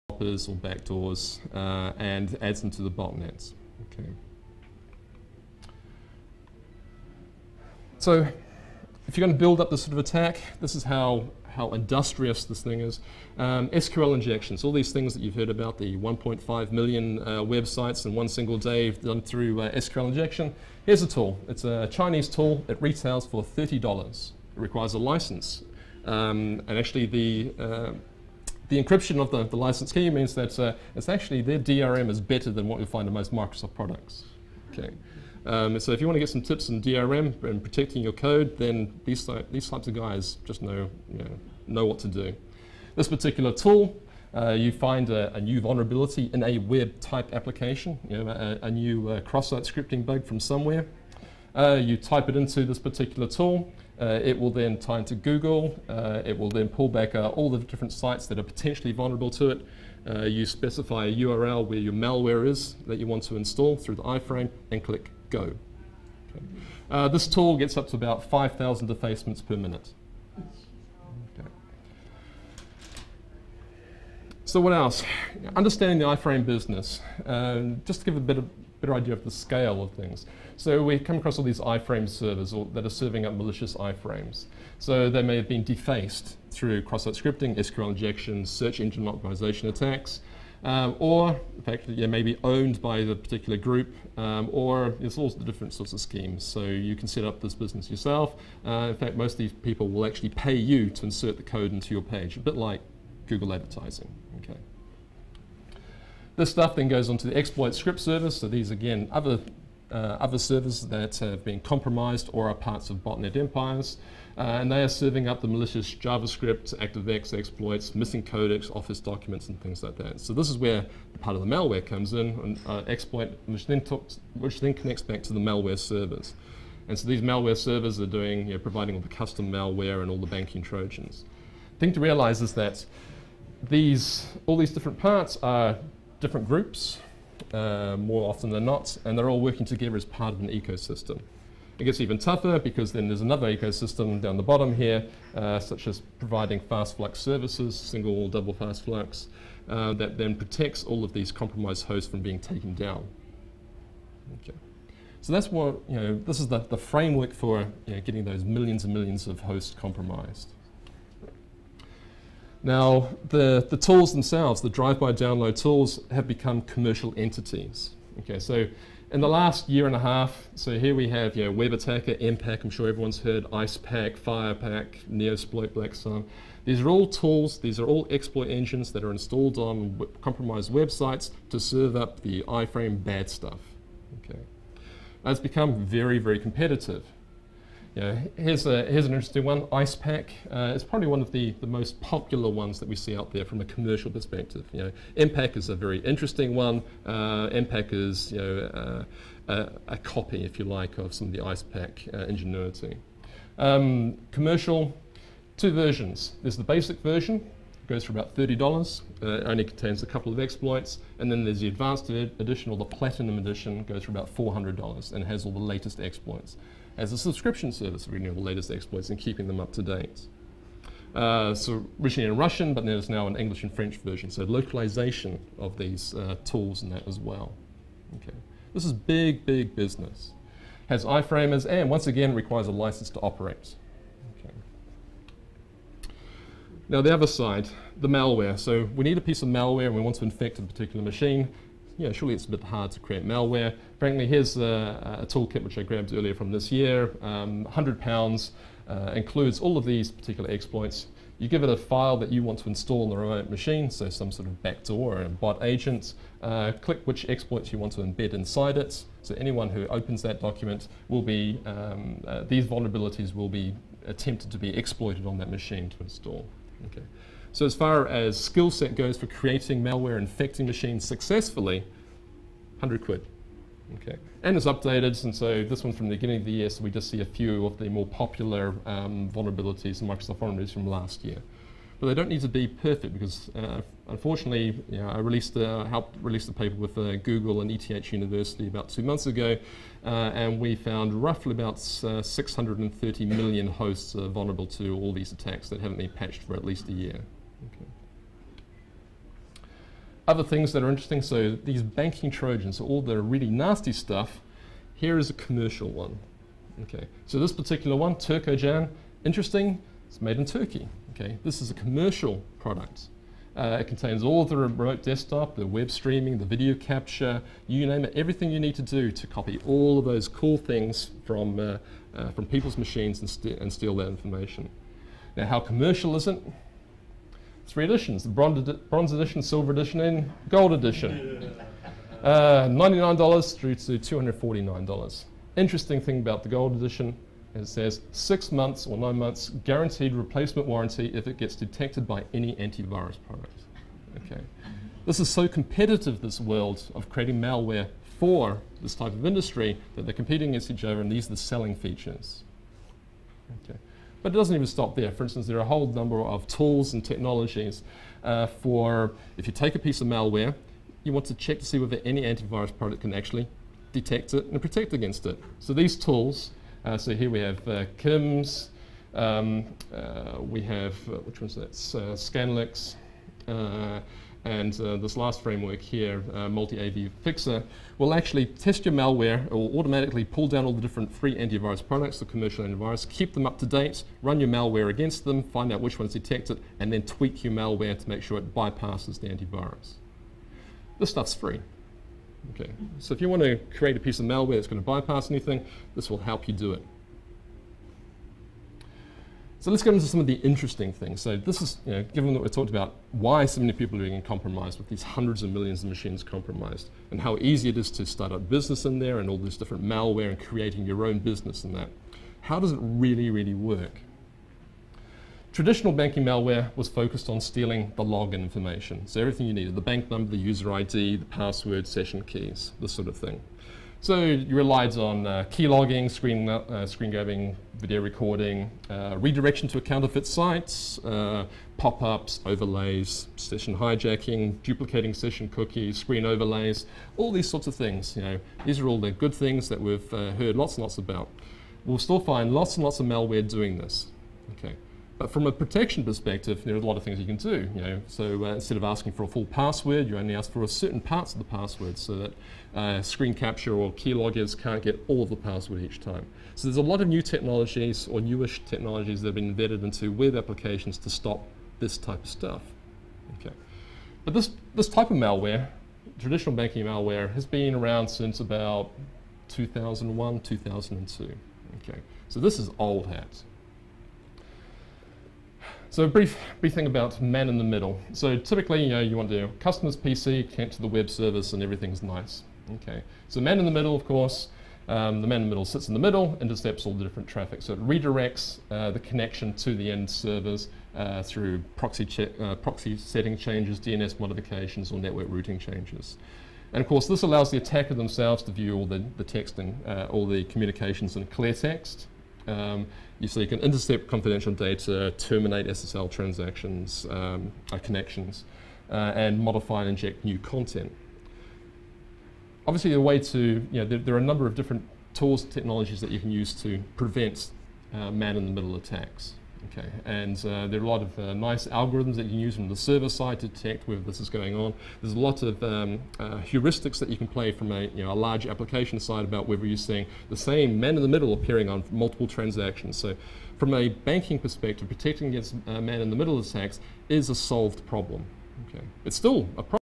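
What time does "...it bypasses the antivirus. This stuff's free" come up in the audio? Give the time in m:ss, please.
6:28.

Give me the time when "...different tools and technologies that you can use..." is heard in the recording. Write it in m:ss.
8:34.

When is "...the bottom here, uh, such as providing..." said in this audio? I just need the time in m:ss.
2:24.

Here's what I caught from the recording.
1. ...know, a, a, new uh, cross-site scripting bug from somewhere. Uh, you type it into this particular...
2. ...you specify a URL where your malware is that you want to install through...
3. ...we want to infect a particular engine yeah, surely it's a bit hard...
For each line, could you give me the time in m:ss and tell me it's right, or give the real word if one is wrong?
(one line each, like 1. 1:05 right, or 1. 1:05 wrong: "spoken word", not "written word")
1. 0:48 right
2. 1:00 right
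3. 3:59 wrong: "machine", not "engine".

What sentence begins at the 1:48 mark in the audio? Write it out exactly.
So these, again, other uh, other servers that have been compromised or are parts of botnet empires.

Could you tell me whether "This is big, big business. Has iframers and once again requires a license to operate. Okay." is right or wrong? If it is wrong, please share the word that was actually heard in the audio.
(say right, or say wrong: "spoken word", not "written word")
right.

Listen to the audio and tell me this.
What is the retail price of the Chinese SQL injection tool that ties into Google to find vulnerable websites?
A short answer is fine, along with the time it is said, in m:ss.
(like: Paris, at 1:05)
$30, at 0:22.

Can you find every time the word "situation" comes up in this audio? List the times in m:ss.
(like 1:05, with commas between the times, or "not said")
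not said.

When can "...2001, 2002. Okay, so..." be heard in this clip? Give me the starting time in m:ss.
7:49.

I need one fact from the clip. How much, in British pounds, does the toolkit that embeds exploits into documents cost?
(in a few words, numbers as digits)
100 pounds.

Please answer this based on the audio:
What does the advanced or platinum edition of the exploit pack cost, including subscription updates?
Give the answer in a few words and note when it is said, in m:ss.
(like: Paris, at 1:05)
$400, at 3:33.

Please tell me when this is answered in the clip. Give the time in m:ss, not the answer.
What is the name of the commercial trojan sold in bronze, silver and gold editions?
5:08.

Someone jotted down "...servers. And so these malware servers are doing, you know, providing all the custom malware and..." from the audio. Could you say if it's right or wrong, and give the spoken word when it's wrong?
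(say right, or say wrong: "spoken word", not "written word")
right.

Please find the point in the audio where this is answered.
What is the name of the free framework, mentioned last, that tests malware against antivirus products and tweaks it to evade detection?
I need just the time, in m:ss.
6:16.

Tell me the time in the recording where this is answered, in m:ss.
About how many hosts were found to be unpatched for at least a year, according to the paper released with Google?
4:52.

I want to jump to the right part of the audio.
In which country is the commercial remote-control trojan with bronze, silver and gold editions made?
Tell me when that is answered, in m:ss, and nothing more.
5:10.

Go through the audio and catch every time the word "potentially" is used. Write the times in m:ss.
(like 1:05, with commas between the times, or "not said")
0:58.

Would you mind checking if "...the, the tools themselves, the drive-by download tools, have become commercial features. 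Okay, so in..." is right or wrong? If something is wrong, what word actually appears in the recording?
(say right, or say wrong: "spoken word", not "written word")
wrong: "entities", not "features".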